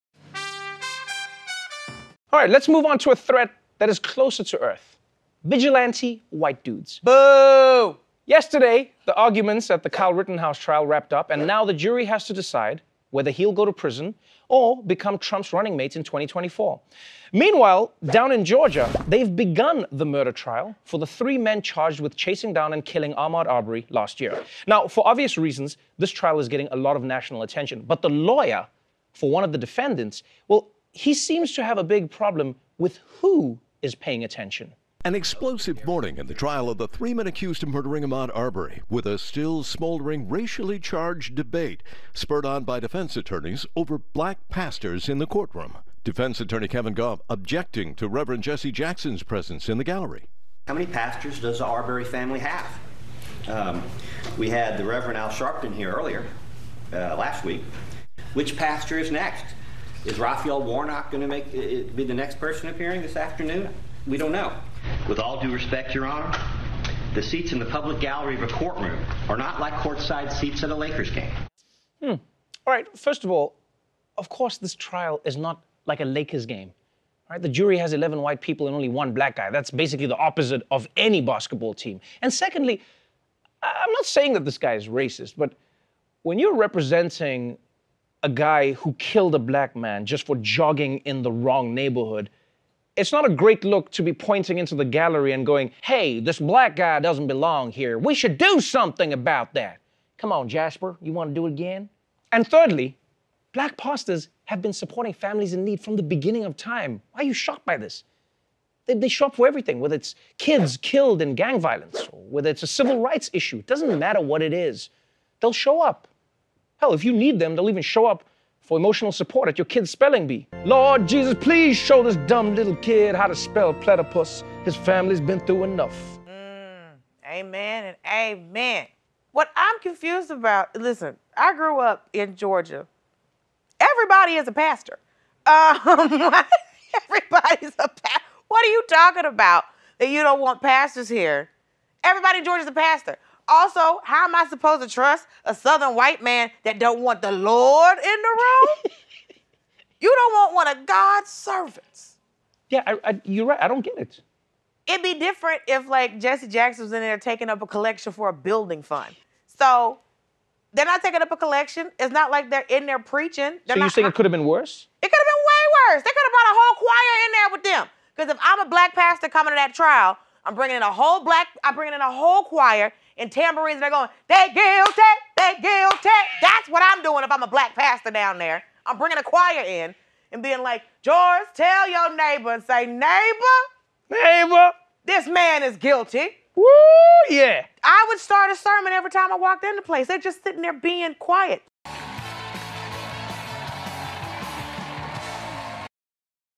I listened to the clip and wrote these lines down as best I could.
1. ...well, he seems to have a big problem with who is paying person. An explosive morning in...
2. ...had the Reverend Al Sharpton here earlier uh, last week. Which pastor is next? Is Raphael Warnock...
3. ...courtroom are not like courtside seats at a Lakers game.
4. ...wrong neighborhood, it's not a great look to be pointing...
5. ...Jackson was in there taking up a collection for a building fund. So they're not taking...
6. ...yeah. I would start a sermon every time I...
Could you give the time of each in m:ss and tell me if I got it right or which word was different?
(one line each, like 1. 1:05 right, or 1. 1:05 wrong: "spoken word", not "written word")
1. 0:30 wrong: "attention", not "person"
2. 0:54 right
3. 1:08 right
4. 1:31 right
5. 2:36 right
6. 3:07 right.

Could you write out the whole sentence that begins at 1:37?
We should do something about that.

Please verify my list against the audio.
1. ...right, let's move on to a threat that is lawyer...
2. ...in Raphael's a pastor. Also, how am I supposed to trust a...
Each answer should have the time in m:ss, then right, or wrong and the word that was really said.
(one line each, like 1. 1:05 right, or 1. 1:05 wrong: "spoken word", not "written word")
1. 0:02 wrong: "closer", not "lawyer"
2. 2:22 wrong: "Georgia", not "Raphael".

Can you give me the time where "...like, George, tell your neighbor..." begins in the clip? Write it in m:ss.
3:00.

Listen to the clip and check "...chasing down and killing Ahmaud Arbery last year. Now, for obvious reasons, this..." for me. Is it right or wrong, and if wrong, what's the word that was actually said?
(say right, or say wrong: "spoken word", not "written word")
right.